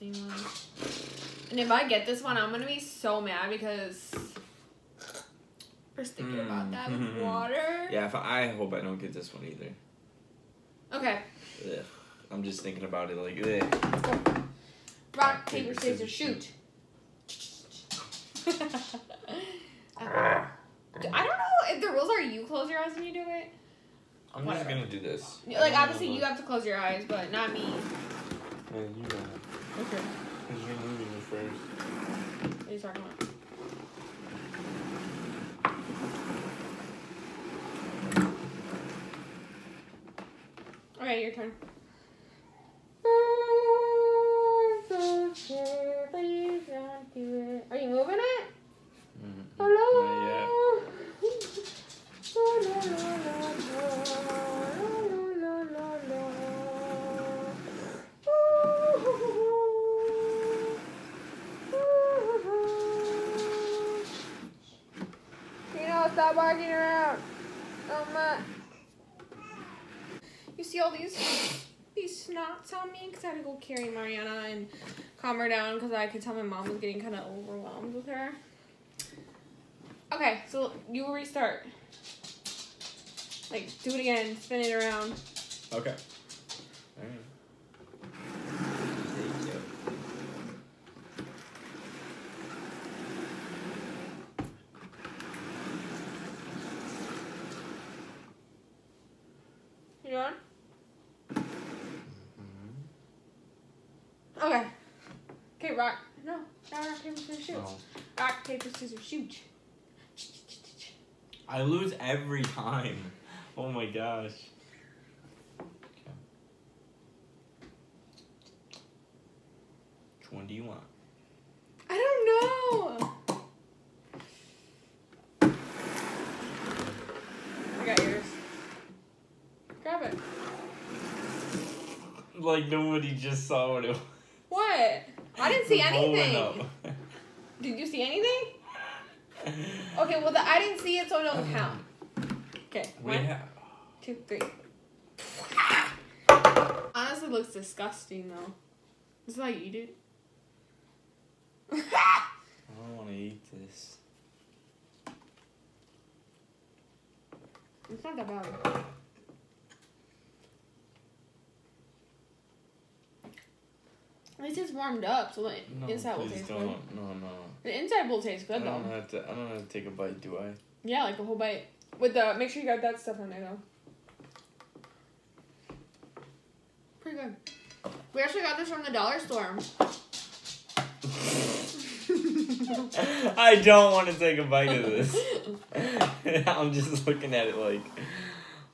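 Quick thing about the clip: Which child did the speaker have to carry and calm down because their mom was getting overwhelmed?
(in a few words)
Mariana.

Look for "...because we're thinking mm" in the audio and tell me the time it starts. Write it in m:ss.
0:03.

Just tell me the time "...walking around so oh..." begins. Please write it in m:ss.
1:06.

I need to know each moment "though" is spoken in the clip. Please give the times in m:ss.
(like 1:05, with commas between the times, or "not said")
2:28, 2:48, 2:53.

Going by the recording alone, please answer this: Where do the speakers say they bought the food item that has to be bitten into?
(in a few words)
the dollar store.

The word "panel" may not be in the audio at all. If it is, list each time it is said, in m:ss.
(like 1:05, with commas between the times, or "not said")
not said.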